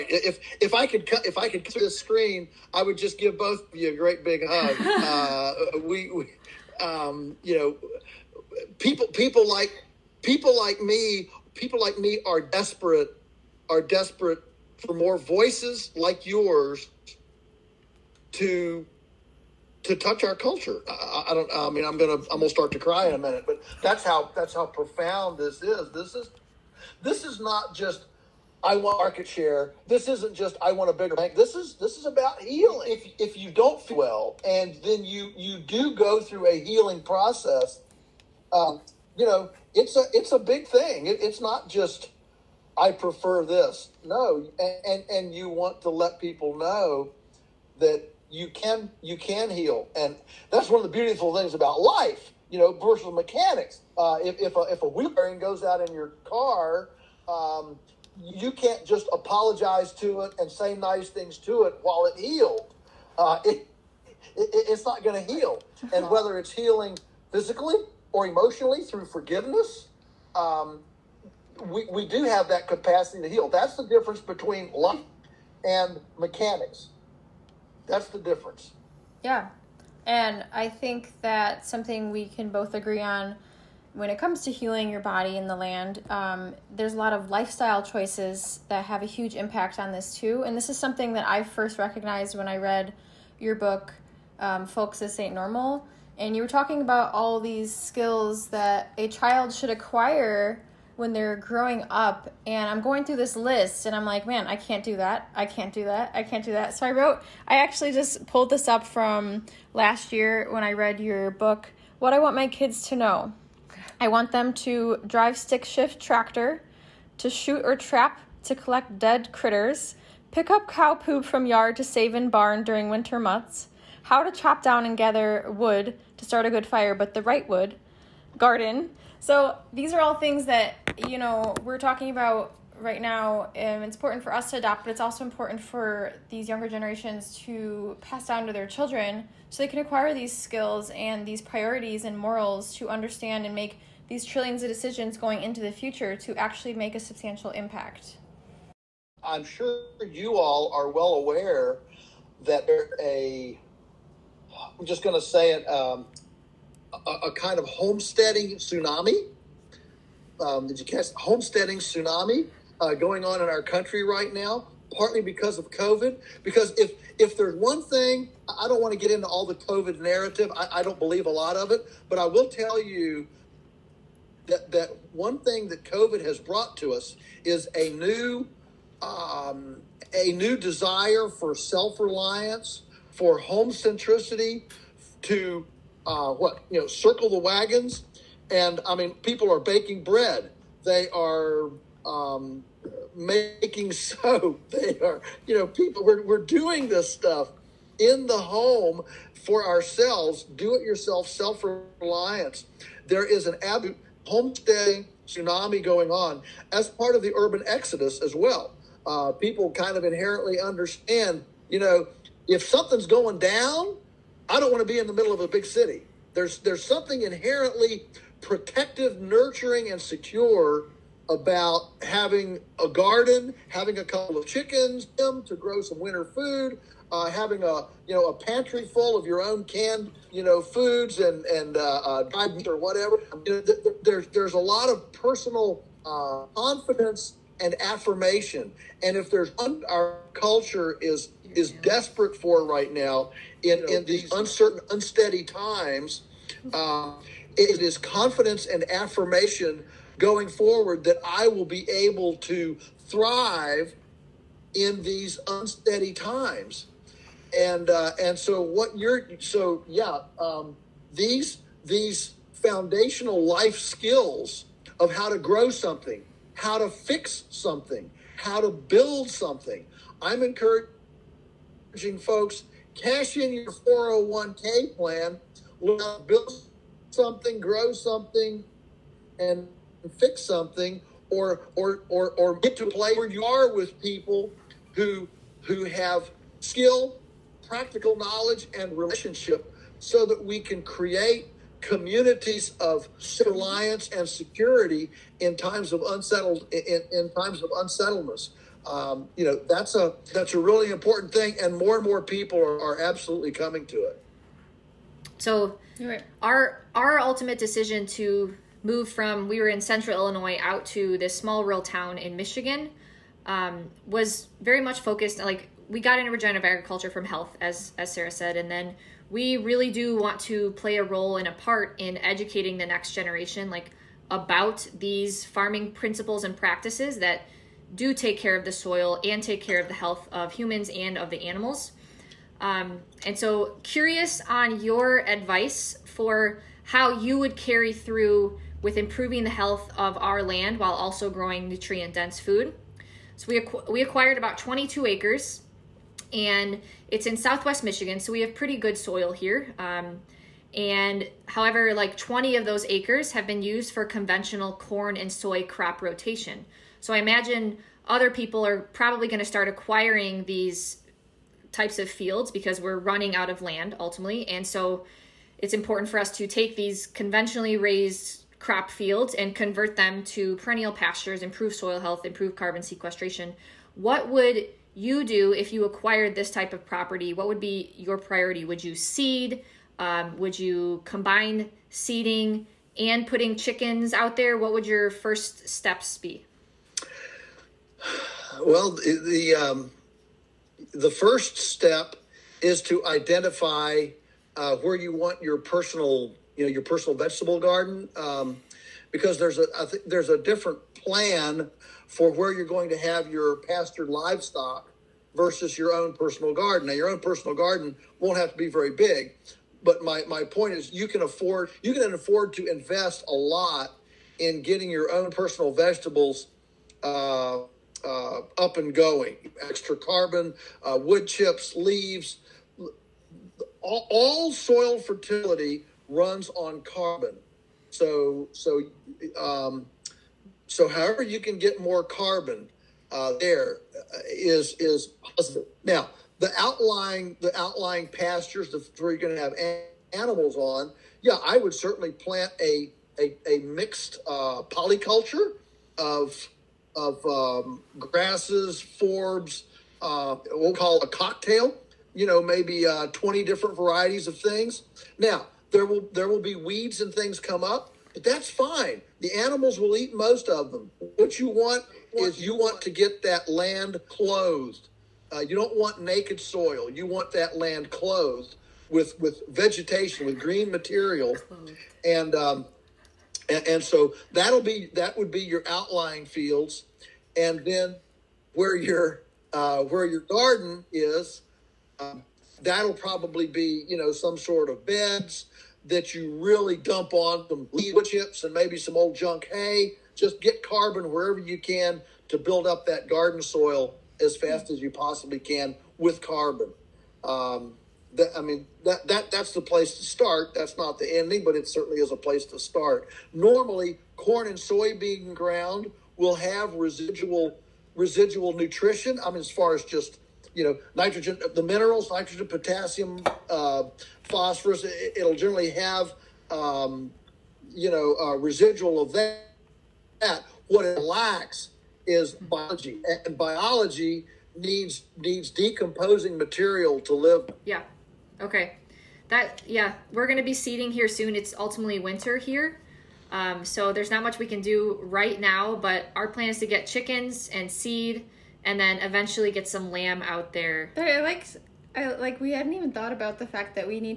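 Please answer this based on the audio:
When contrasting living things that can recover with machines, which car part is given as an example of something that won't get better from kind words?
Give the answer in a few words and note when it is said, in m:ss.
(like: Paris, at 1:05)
wheel bearing, at 0:54.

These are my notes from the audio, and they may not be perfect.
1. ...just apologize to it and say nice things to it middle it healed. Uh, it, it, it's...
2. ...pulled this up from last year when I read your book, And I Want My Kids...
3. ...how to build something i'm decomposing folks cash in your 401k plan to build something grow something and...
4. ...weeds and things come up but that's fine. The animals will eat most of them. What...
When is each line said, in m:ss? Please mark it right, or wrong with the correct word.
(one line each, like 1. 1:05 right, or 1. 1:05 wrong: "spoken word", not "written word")
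1. 0:58 wrong: "while", not "middle"
2. 1:48 wrong: "What", not "And"
3. 4:28 wrong: "encouraging", not "decomposing"
4. 7:36 right.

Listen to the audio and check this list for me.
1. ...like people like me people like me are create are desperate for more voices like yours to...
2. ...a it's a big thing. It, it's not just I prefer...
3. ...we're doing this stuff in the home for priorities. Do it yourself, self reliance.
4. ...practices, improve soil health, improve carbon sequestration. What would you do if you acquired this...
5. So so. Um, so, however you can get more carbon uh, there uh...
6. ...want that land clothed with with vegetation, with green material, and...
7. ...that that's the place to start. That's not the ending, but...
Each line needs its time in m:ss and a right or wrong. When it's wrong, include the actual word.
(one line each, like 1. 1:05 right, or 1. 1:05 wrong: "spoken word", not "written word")
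1. 0:09 wrong: "desperate", not "create"
2. 0:39 right
3. 3:16 wrong: "ourselves", not "priorities"
4. 6:10 wrong: "pastures", not "practices"
5. 7:07 right
6. 7:47 right
7. 8:19 right.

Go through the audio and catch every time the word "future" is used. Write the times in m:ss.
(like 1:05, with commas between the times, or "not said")
2:25.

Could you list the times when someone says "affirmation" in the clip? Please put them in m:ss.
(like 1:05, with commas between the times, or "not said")
3:57, 4:08.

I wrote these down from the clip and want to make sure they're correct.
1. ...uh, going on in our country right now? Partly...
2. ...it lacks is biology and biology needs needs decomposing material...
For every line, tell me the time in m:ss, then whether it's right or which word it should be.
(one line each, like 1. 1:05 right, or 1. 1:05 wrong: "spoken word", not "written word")
1. 2:42 right
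2. 8:40 right.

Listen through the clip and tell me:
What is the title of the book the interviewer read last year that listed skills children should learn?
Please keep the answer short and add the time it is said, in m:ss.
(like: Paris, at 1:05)
Folks This Ain't Normal, at 1:34.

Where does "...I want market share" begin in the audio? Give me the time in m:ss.
0:28.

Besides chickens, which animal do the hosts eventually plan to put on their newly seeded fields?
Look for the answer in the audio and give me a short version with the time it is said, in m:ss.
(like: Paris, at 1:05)
lamb, at 8:59.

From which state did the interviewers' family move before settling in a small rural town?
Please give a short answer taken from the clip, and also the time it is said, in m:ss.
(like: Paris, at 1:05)
Illinois, at 5:10.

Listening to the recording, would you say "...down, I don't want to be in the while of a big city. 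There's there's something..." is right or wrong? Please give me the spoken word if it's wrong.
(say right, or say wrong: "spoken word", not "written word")
wrong: "middle", not "while".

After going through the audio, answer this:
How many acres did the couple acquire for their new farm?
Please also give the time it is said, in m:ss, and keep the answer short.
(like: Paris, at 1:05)
22, at 5:44.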